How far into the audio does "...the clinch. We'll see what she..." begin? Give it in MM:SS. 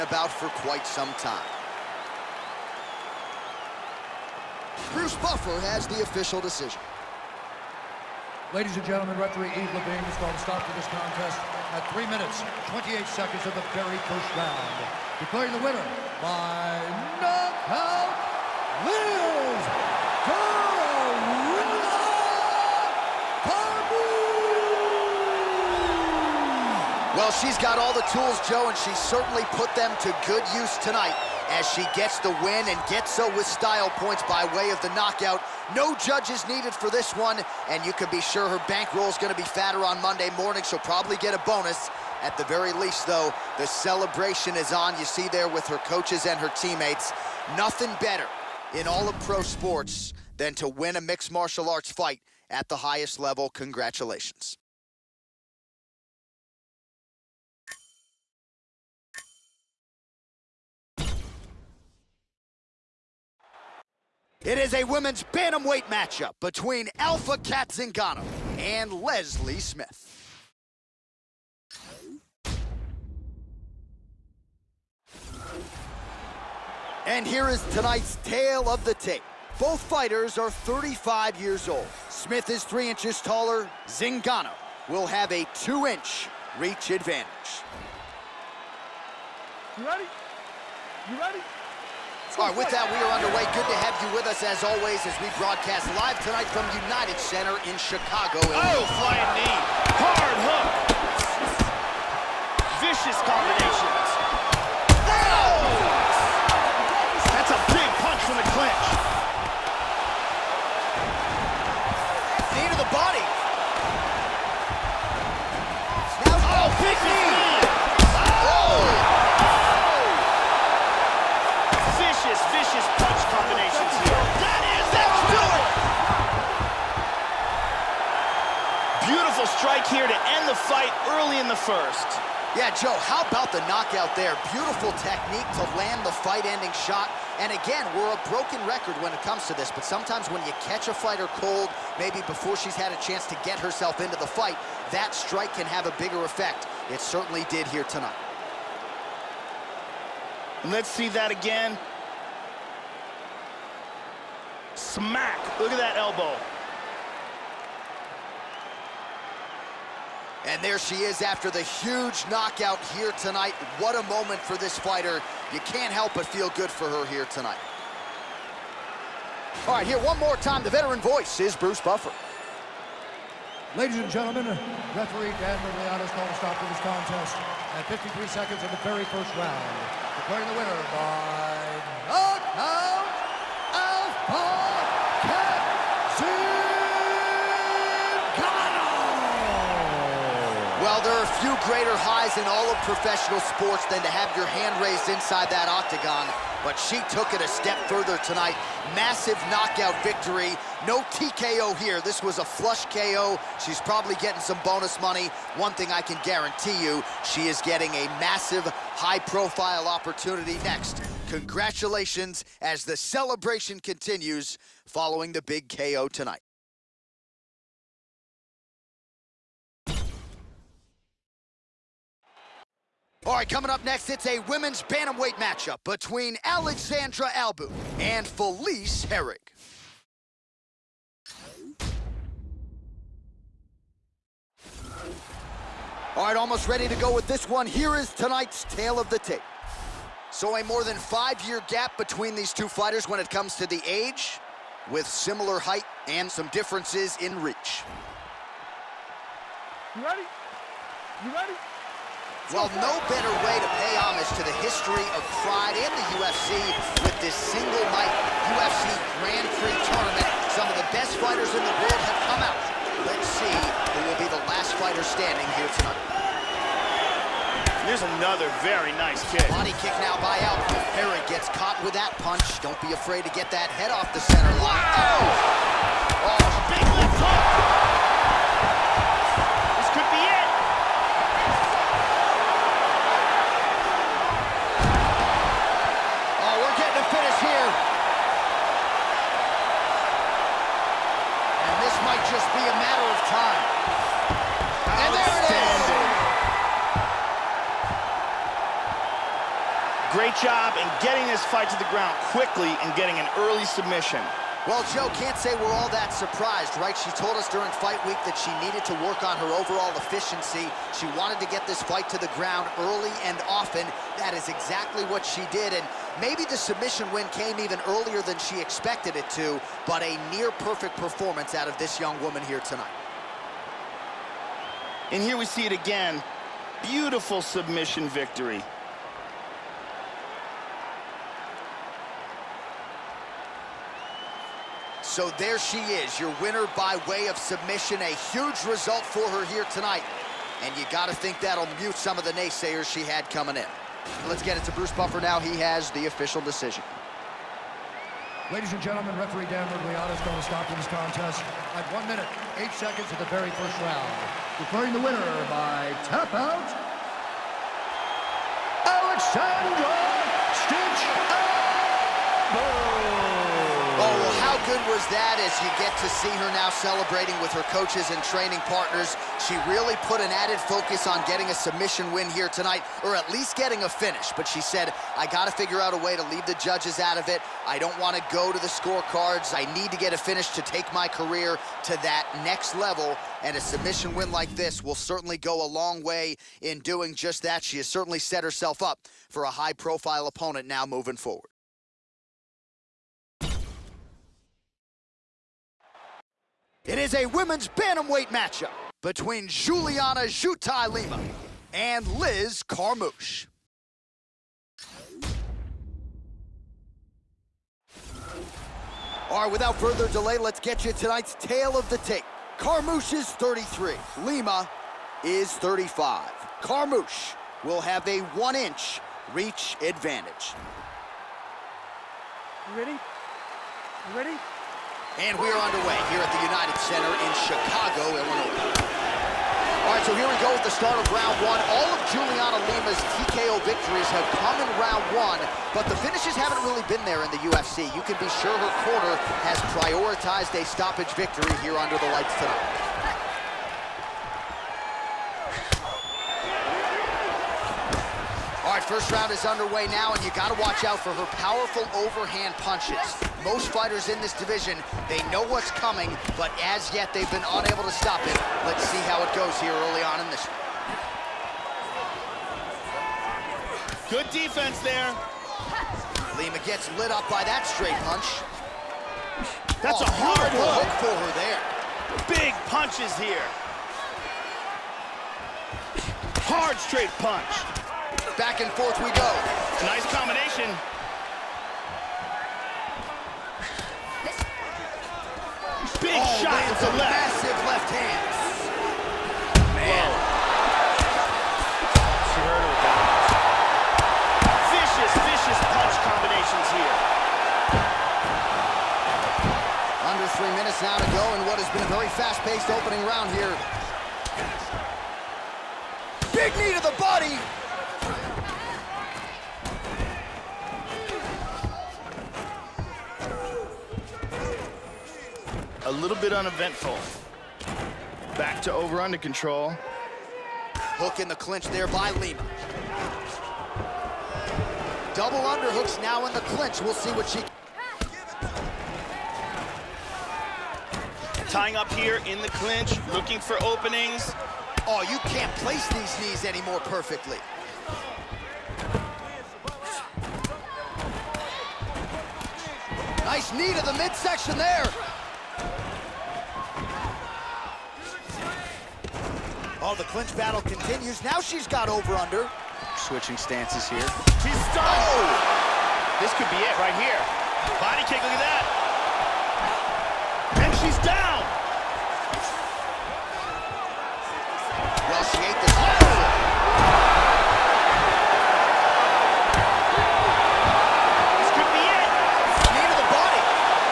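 08:46.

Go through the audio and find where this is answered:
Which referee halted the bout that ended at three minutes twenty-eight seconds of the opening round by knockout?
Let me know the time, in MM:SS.
00:09.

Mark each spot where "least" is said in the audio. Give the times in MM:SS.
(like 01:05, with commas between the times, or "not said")
00:42, 06:13.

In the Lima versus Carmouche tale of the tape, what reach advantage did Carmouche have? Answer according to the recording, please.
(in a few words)
1 inch.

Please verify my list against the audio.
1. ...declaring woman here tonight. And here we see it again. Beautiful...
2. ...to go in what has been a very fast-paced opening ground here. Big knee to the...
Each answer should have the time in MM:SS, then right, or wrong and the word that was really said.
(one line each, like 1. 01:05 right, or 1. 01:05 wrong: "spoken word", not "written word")
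1. 05:22 wrong: "young", not "declaring"
2. 08:20 wrong: "round", not "ground".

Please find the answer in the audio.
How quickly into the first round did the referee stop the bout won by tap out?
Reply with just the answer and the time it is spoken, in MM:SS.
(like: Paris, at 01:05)
1 minute, 8 seconds, at 05:51.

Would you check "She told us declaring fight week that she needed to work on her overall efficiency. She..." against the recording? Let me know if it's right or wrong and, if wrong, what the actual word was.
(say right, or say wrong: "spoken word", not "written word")
wrong: "during", not "declaring".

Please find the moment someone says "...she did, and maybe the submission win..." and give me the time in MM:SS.
05:15.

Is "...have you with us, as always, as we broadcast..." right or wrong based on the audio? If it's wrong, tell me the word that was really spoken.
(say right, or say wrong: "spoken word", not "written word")
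right.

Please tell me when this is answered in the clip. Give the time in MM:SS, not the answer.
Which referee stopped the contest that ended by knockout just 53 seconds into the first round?
02:55.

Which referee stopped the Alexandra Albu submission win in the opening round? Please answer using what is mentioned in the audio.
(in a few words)
Dan Miragliotta.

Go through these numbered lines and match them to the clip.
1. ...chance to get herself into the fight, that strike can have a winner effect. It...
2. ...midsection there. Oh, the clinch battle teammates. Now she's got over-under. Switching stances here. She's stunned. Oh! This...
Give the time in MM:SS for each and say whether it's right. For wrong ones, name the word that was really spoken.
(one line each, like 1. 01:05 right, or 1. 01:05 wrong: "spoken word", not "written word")
1. 02:23 wrong: "bigger", not "winner"
2. 09:04 wrong: "continues", not "teammates".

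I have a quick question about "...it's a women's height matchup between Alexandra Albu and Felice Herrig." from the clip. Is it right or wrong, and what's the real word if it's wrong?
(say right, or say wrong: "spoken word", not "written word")
wrong: "bantamweight", not "height".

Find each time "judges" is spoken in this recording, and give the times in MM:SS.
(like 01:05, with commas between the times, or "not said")
00:36, 06:16.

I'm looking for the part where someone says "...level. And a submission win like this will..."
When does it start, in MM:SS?
06:22.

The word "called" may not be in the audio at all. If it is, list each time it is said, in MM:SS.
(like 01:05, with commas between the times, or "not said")
00:10, 02:56.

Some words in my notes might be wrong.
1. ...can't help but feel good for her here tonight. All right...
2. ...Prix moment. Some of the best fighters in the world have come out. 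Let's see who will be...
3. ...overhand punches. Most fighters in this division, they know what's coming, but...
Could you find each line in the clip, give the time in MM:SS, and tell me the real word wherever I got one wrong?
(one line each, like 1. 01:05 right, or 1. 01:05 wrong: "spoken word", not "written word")
1. 02:45 right
2. 04:19 wrong: "tournament", not "moment"
3. 07:31 right.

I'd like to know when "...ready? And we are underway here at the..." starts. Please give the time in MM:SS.
07:04.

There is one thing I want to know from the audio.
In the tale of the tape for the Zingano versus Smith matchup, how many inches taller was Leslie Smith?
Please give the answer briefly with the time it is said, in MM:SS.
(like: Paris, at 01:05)
3 inches, at 01:22.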